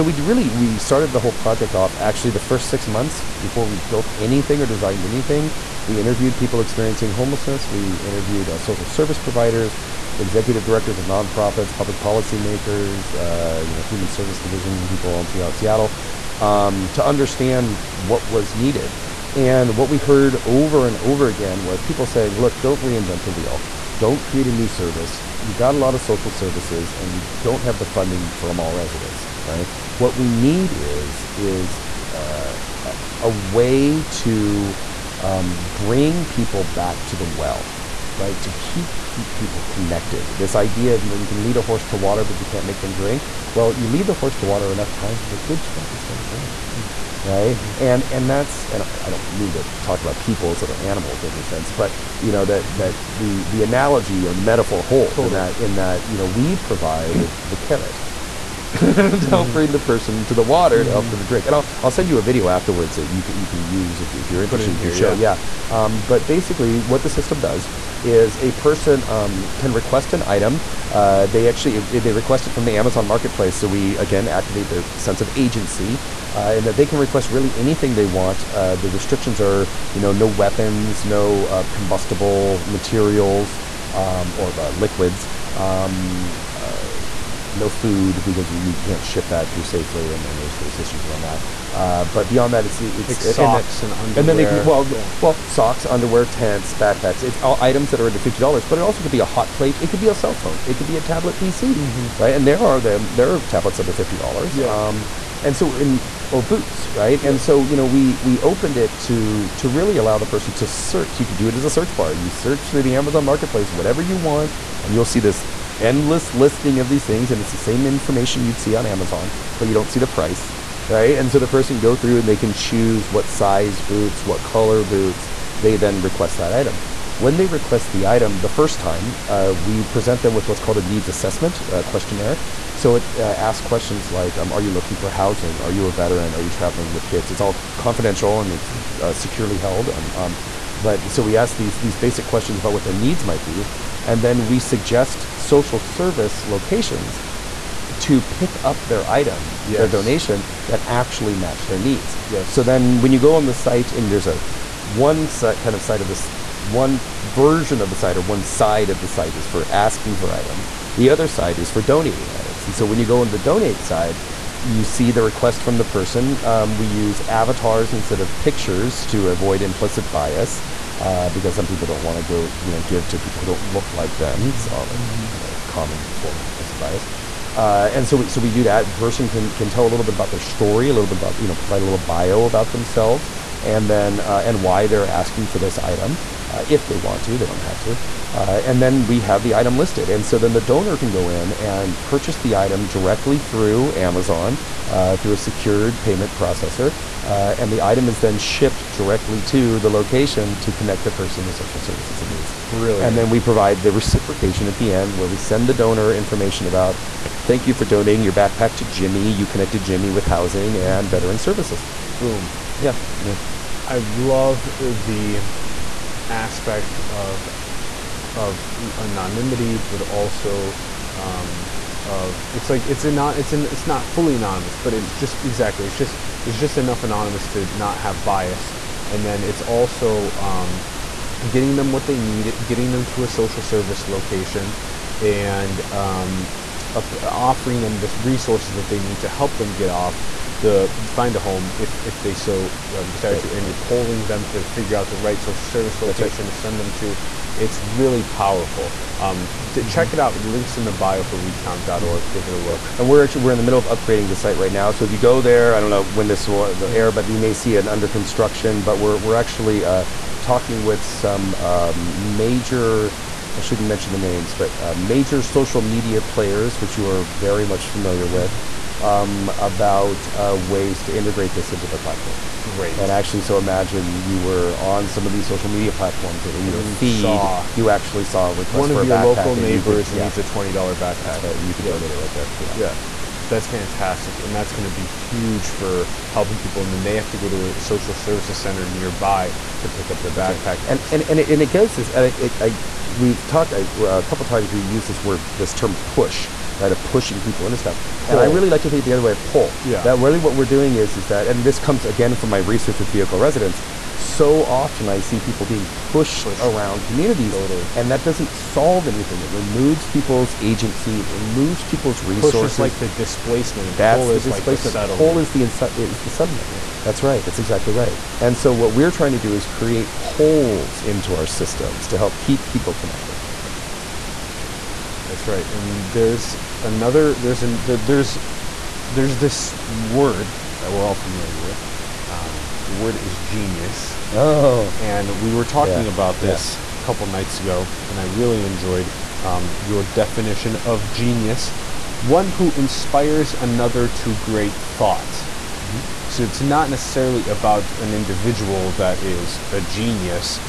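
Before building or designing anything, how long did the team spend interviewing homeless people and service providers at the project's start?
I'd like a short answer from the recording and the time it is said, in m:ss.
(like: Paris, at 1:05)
6 months, at 0:02.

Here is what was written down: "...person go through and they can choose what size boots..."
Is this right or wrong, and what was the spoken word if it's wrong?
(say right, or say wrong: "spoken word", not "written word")
right.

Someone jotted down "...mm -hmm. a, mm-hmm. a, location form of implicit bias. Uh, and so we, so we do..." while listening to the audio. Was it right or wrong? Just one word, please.
wrong.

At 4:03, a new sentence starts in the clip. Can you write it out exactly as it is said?
you're polling them to figure out the right social service location right.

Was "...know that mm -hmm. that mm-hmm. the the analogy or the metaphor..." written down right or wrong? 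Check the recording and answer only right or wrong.
right.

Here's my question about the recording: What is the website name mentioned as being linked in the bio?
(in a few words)
WeCount.org.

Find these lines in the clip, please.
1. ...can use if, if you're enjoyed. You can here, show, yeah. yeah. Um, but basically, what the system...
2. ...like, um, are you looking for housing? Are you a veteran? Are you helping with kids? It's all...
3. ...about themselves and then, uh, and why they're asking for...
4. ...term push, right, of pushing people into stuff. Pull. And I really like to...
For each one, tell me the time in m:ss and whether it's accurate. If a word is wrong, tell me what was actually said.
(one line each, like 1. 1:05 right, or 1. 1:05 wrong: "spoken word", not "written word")
1. 1:03 wrong: "interested", not "enjoyed"
2. 2:14 wrong: "traveling", not "helping"
3. 3:02 right
4. 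4:55 right.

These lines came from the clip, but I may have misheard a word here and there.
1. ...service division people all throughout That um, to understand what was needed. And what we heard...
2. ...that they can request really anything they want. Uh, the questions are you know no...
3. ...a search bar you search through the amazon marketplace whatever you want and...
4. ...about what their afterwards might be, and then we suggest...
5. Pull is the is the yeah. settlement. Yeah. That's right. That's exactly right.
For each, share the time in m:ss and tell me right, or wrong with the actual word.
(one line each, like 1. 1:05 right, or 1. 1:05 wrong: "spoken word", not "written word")
1. 0:14 wrong: "Seattle", not "That"
2. 1:16 wrong: "restrictions", not "questions"
3. 1:51 right
4. 2:22 wrong: "needs", not "afterwards"
5. 5:15 right.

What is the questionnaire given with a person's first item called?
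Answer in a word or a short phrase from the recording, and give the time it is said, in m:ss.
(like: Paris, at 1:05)
Needs assessment, at 2:10.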